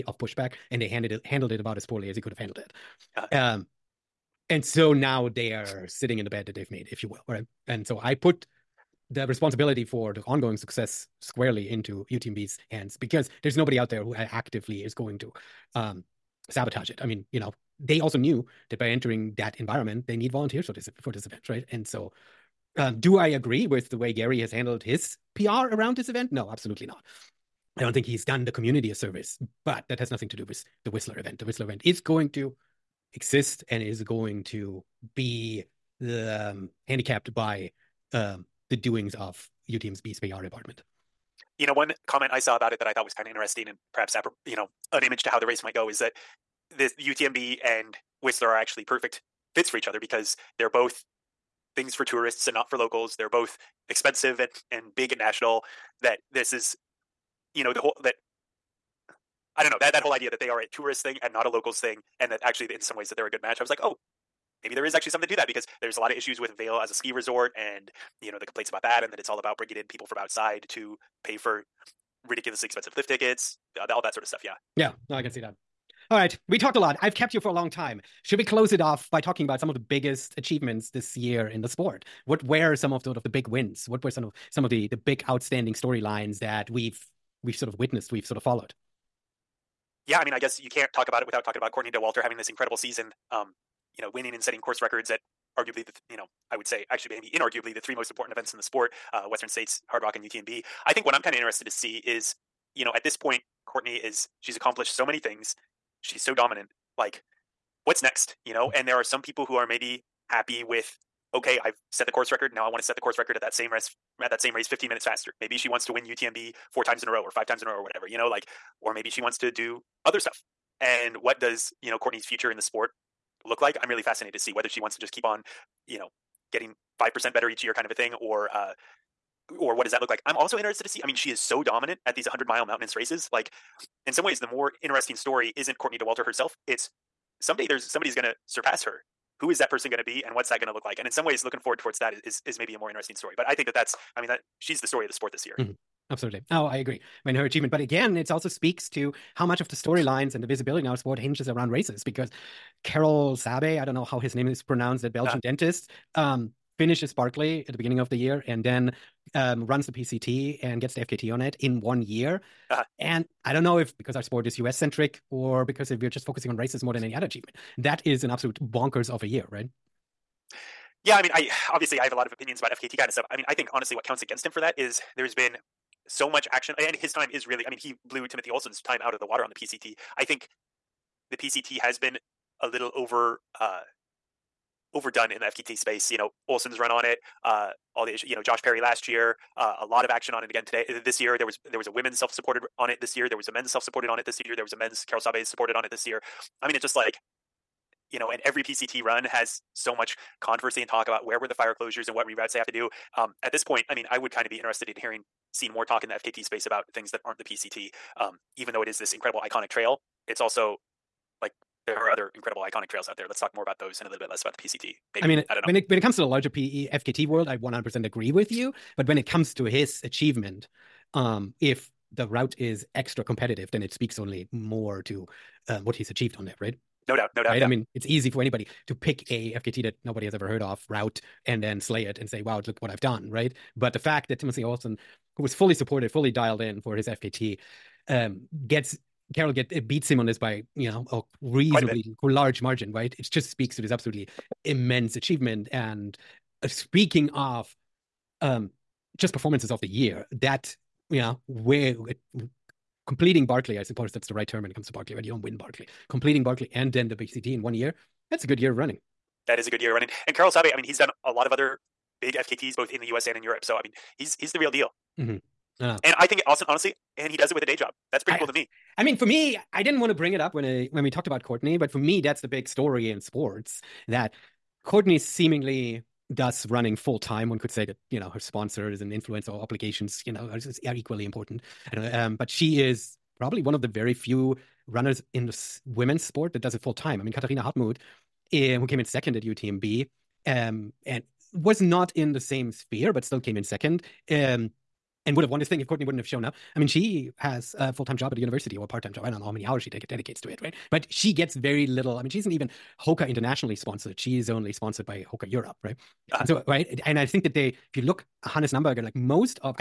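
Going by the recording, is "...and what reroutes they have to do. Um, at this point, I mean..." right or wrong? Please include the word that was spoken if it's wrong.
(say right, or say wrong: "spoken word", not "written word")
right.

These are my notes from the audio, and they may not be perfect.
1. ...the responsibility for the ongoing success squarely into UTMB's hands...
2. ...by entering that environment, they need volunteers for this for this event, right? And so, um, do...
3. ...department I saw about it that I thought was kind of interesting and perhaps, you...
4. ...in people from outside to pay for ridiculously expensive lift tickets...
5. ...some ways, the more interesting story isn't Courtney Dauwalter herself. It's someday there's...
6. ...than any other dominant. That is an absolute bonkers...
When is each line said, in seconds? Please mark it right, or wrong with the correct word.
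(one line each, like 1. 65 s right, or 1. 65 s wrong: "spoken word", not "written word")
1. 9 s right
2. 18 s right
3. 42 s wrong: "comment", not "department"
4. 69 s right
5. 134 s right
6. 166 s wrong: "achievement", not "dominant".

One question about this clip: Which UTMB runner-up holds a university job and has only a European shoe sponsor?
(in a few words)
Katharina Hartmuth.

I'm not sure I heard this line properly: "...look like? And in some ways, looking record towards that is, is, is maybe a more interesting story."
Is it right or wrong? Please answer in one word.
wrong.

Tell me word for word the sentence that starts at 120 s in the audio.
And what does, you know, Courtney's future in the sport look like?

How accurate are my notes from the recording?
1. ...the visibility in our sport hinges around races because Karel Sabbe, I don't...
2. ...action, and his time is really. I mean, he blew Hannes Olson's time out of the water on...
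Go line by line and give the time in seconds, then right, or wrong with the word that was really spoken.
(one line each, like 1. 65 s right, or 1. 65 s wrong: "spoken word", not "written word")
1. 150 s right
2. 176 s wrong: "Timothy", not "Hannes".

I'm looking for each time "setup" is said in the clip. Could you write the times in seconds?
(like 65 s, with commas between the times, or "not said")
not said.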